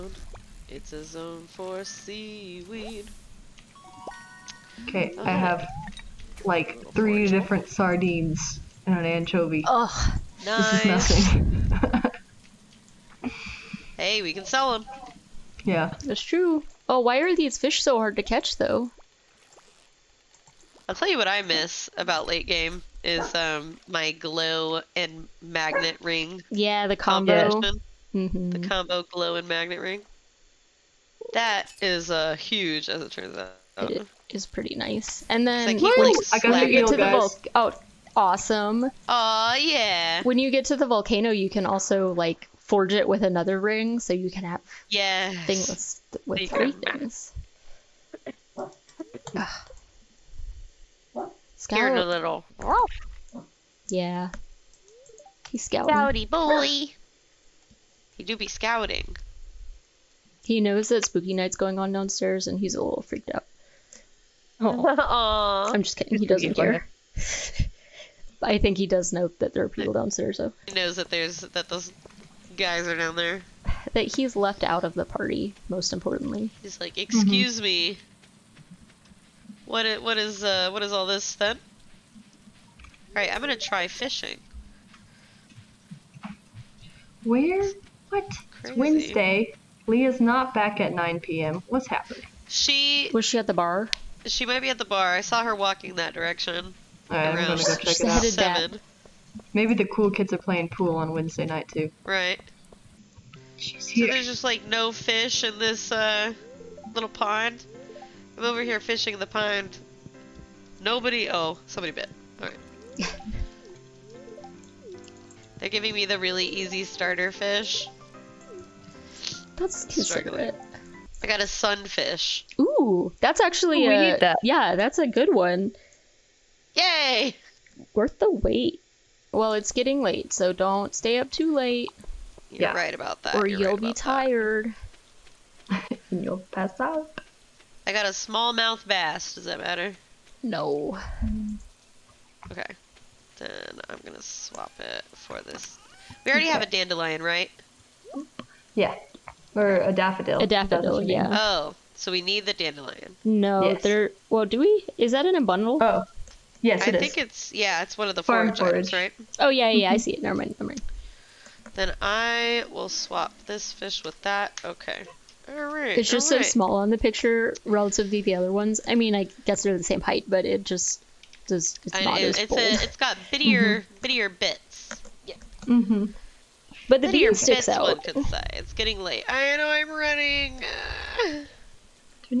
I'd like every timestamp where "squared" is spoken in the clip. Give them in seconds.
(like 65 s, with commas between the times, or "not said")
not said.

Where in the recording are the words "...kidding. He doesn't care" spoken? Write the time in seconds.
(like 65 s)
65 s.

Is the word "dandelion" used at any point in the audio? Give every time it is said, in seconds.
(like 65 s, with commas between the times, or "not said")
146 s, 152 s.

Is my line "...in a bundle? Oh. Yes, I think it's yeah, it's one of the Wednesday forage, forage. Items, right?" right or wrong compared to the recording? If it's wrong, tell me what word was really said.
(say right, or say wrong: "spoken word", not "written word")
wrong: "Farm", not "Wednesday".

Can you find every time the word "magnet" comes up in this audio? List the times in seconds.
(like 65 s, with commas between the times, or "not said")
25 s, 29 s.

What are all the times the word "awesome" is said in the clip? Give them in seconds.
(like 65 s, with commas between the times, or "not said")
38 s.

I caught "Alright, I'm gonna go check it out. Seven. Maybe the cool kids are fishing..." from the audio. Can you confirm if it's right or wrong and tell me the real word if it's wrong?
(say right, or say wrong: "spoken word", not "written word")
wrong: "playing", not "fishing".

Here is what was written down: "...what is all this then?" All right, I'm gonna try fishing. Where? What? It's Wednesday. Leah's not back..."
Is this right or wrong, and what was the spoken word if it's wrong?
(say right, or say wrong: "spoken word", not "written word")
right.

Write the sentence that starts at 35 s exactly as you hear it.
And then I keep, get to guys.